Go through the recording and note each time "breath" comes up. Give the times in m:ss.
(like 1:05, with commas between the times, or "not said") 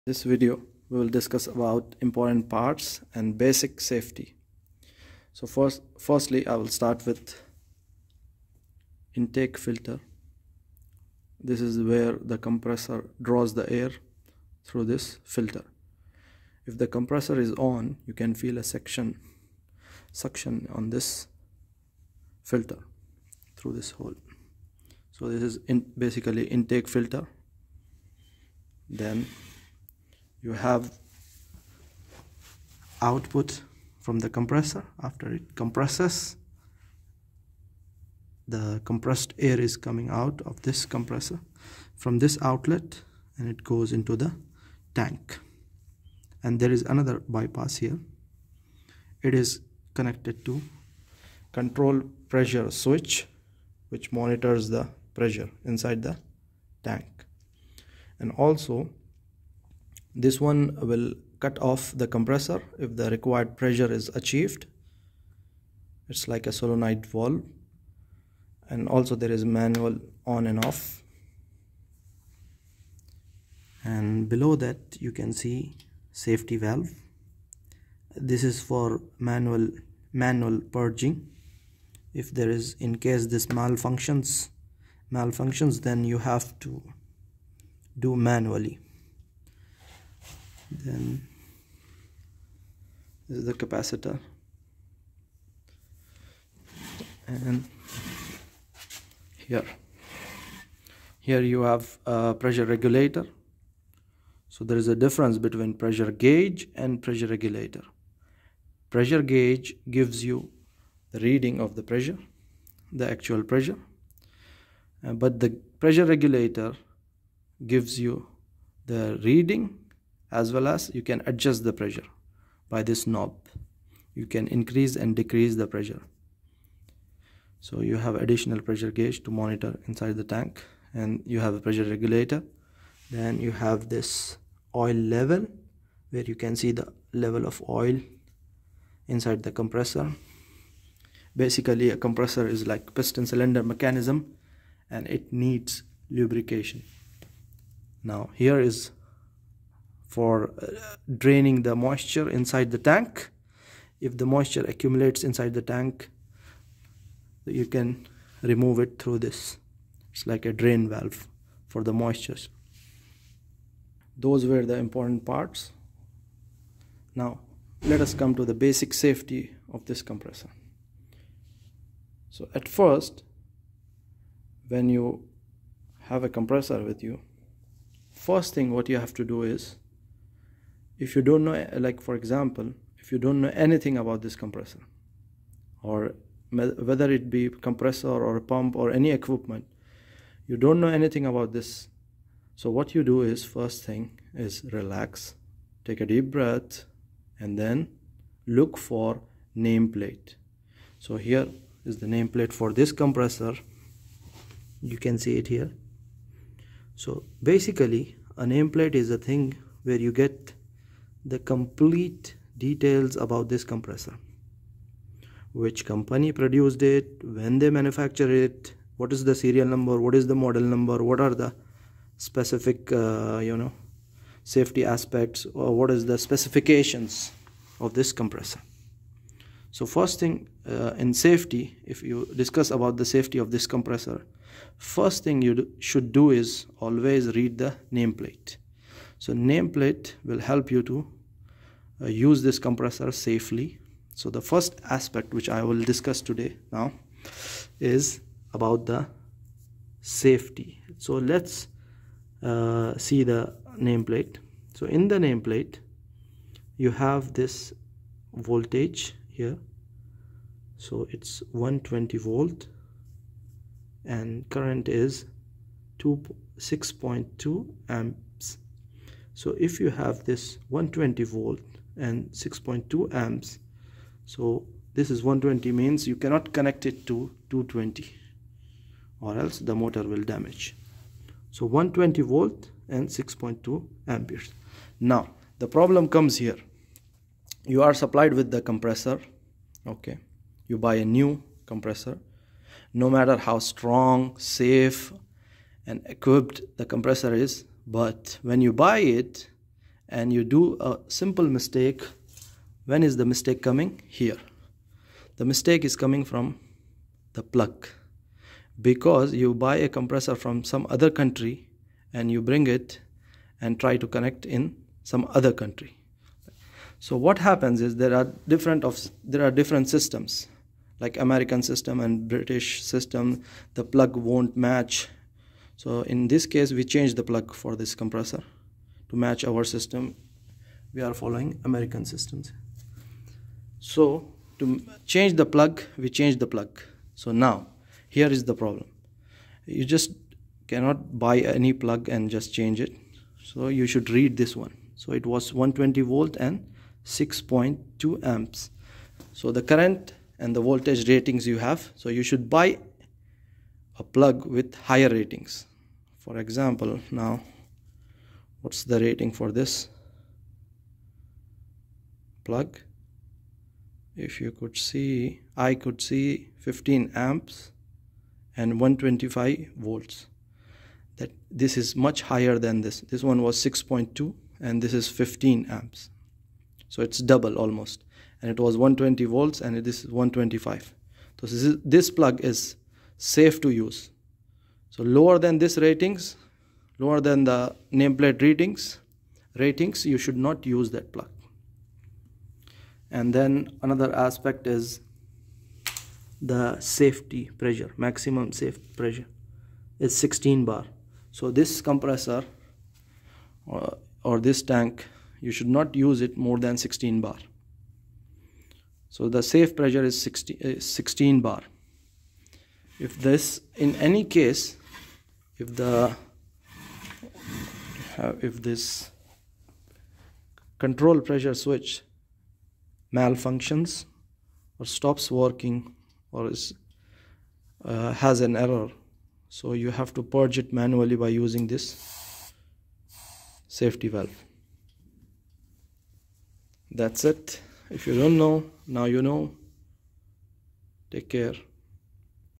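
3:16.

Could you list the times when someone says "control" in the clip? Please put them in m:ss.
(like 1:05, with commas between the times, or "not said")
0:51, 7:00.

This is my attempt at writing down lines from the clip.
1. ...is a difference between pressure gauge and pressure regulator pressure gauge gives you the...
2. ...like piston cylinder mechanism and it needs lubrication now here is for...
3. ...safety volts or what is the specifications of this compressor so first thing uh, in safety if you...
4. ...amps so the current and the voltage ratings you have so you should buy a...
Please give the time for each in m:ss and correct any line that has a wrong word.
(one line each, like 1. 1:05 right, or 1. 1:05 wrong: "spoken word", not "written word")
1. 1:44 right
2. 2:22 right
3. 3:44 wrong: "aspects", not "volts"
4. 5:48 right.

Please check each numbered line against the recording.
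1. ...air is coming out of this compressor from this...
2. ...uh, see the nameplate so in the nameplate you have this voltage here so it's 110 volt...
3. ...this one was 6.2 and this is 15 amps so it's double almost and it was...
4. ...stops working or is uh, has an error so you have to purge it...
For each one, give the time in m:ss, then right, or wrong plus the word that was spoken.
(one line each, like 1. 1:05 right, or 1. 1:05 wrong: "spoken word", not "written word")
1. 0:39 right
2. 4:12 wrong: "120", not "110"
3. 6:13 right
4. 7:04 right.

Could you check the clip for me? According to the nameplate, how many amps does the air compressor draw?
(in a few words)
6.2 amps.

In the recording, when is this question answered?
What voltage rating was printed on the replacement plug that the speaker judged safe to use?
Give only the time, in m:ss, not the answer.
6:08.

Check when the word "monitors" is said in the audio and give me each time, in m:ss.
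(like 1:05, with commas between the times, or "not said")
0:54, 2:09.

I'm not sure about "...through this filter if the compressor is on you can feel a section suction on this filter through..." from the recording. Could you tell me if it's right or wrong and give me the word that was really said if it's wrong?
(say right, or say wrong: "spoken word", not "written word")
right.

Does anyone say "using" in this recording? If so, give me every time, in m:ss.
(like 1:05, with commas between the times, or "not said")
7:11.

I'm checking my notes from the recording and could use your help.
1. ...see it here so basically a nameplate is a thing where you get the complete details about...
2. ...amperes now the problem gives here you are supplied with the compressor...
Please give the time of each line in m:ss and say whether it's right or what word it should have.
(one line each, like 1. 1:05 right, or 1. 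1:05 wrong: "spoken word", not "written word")
1. 3:25 right
2. 4:44 wrong: "comes", not "gives".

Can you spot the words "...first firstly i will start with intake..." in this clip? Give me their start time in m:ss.
0:05.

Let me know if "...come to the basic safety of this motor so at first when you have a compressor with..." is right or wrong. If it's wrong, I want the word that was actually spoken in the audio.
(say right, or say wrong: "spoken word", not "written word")
wrong: "compressor", not "motor".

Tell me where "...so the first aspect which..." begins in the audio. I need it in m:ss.
4:04.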